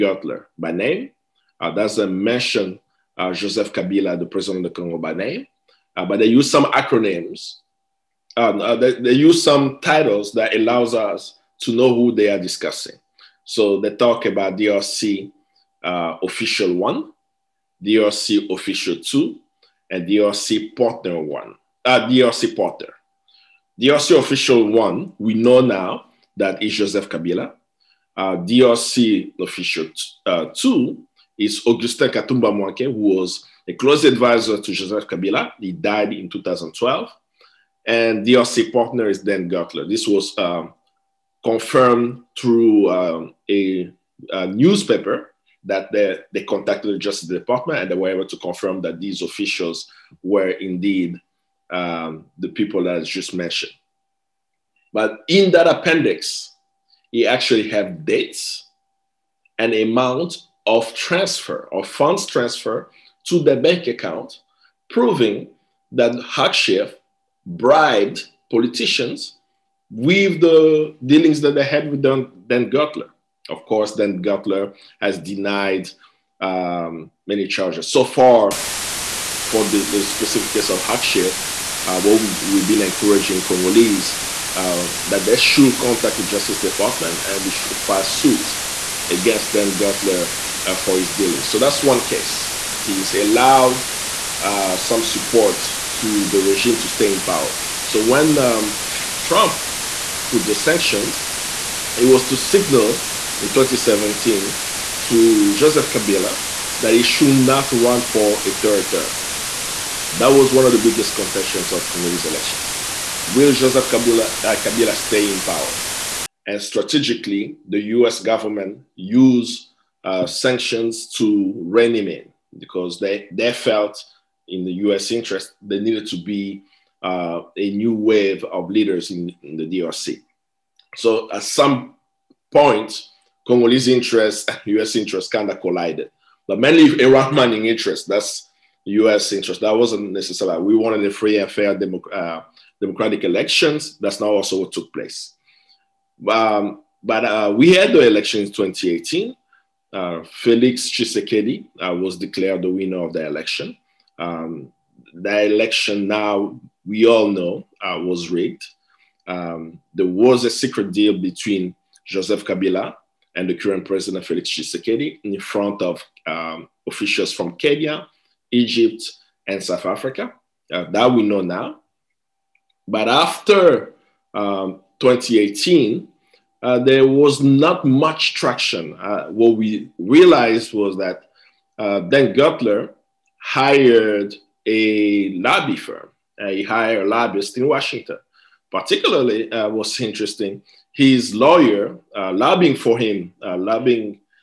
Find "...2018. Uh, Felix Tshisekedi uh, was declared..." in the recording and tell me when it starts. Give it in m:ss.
2:28.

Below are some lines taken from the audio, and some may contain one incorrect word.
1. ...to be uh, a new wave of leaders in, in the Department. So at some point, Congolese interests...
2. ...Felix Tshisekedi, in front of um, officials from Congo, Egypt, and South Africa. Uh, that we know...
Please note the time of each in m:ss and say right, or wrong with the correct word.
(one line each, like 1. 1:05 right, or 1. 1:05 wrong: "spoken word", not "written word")
1. 2:06 wrong: "DRC", not "Department"
2. 2:44 wrong: "Kenya", not "Congo".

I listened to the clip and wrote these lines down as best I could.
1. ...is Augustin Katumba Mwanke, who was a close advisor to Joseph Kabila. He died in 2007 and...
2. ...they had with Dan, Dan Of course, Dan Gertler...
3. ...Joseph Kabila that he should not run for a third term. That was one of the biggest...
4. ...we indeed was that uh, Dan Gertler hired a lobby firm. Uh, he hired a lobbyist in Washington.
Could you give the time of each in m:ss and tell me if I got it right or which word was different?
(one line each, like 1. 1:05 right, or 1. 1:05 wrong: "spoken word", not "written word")
1. 0:31 wrong: "2012", not "2007"
2. 1:11 right
3. 1:45 right
4. 2:59 wrong: "realized", not "indeed".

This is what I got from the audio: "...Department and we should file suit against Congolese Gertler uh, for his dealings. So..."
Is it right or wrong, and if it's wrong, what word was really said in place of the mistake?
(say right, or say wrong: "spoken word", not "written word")
wrong: "Dan", not "Congolese".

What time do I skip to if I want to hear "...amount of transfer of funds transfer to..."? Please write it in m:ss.
0:59.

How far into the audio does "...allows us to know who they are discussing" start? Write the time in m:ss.
0:10.